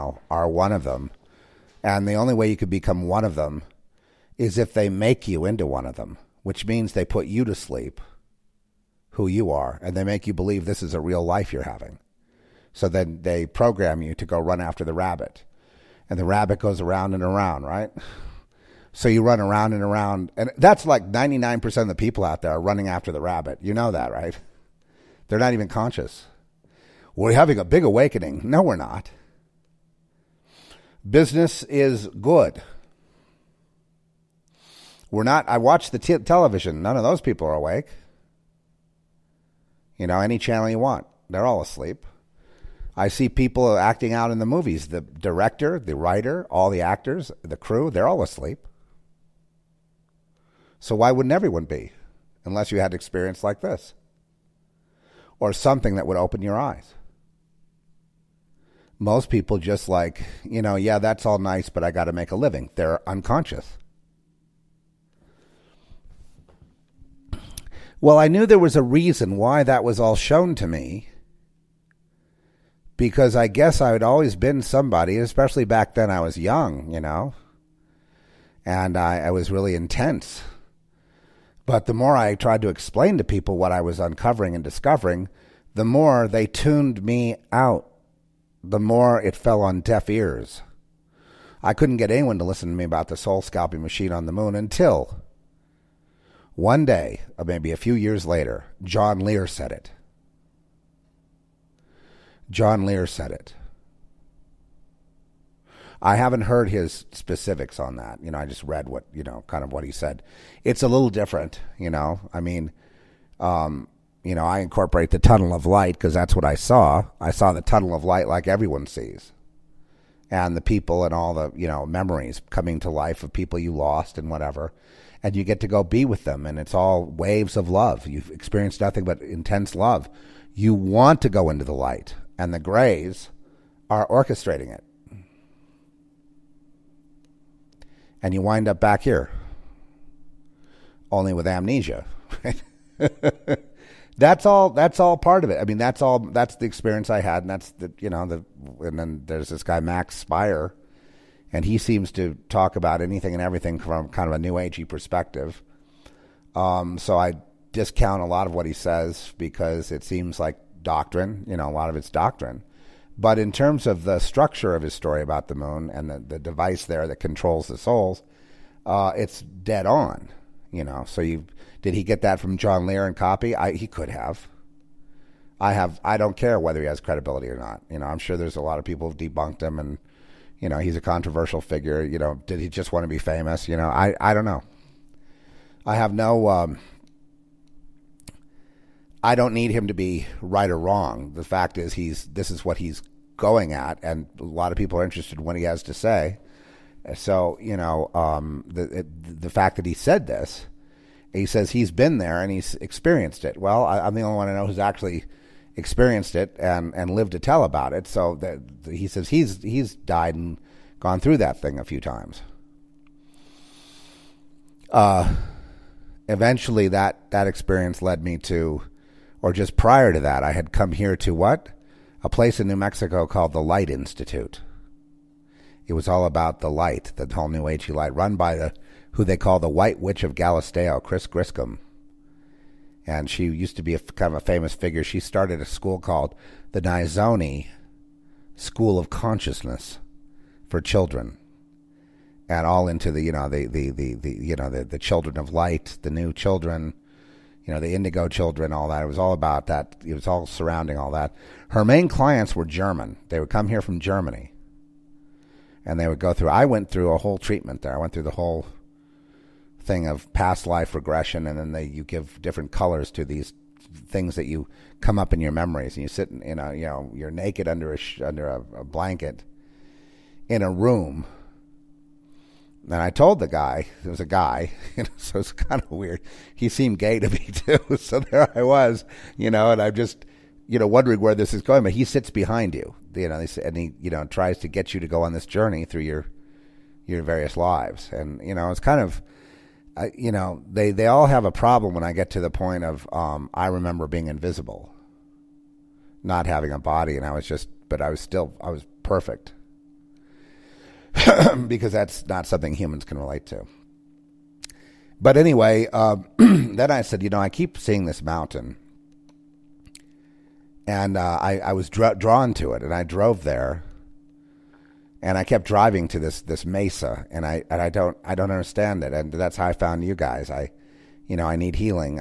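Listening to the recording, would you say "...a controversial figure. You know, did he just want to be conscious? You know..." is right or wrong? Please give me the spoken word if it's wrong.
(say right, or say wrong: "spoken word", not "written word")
wrong: "famous", not "conscious".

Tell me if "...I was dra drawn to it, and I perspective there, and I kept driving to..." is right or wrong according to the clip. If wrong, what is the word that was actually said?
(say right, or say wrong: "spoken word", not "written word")
wrong: "drove", not "perspective".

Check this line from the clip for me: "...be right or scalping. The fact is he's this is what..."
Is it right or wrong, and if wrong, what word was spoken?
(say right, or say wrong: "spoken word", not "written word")
wrong: "wrong", not "scalping".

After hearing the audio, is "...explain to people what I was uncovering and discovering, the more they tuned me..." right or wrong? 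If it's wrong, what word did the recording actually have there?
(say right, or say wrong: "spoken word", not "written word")
right.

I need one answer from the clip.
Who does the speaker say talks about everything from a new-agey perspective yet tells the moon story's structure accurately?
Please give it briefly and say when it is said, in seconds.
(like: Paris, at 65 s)
Max Spire, at 149 s.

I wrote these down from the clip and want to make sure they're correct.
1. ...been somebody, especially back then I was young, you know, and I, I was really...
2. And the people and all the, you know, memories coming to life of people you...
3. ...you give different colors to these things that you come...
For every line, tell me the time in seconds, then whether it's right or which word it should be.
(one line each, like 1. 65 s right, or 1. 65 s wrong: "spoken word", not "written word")
1. 74 s right
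2. 120 s right
3. 261 s right.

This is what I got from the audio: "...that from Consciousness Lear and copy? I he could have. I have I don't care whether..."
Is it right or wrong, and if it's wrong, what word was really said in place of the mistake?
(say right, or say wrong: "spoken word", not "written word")
wrong: "John", not "Consciousness".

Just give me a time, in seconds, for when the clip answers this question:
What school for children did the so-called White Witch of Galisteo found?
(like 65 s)
236 s.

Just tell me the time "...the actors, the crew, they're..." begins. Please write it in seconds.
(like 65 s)
46 s.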